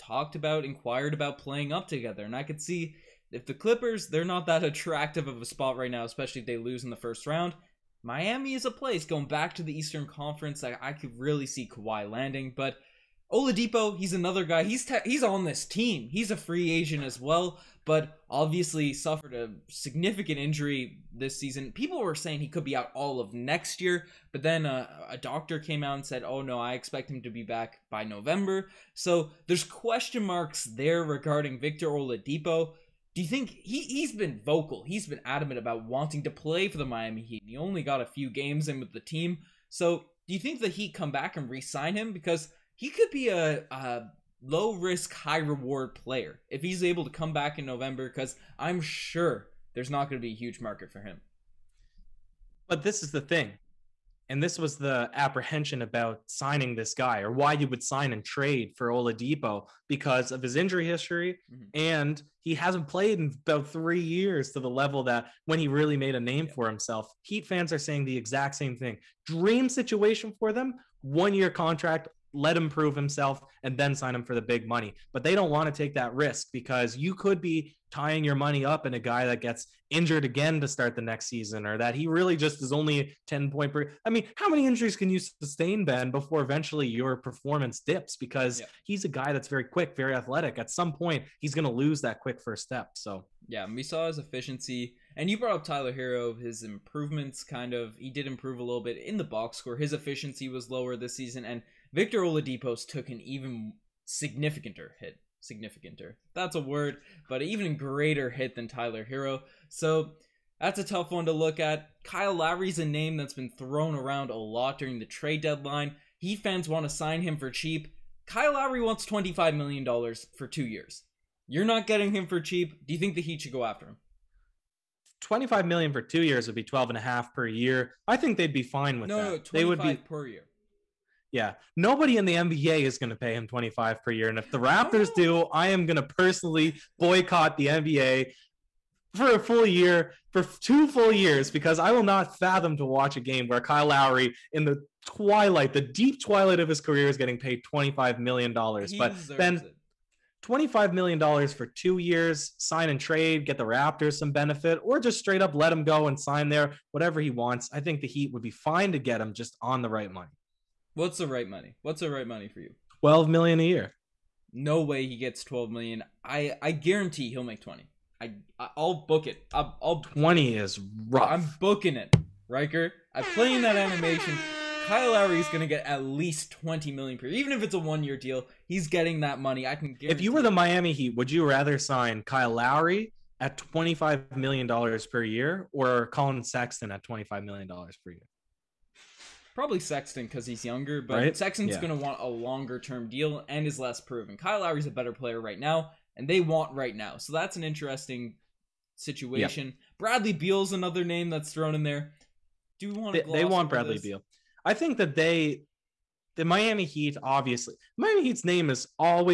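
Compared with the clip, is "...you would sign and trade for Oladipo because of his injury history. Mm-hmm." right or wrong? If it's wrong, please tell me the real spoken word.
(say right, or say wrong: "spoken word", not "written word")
right.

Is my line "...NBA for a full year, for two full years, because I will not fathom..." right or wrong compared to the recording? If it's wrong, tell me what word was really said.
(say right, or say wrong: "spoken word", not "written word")
right.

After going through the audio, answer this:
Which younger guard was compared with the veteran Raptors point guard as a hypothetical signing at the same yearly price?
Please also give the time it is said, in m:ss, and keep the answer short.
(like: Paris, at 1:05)
Collin Sexton, at 3:06.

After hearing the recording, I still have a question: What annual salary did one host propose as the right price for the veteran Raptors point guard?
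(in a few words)
12 million.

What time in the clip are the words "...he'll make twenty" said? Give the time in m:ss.
2:47.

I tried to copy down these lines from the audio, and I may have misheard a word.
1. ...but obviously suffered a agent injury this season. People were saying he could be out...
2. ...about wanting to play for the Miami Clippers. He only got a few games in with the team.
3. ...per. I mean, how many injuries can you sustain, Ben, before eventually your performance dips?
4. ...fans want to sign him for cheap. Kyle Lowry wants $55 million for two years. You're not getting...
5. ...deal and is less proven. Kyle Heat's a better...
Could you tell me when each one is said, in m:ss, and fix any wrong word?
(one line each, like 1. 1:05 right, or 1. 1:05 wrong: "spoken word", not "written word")
1. 0:17 wrong: "significant", not "agent"
2. 0:35 wrong: "Heat", not "Clippers"
3. 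1:23 right
4. 1:56 wrong: "25", not "55"
5. 3:13 wrong: "Lowry", not "Heat".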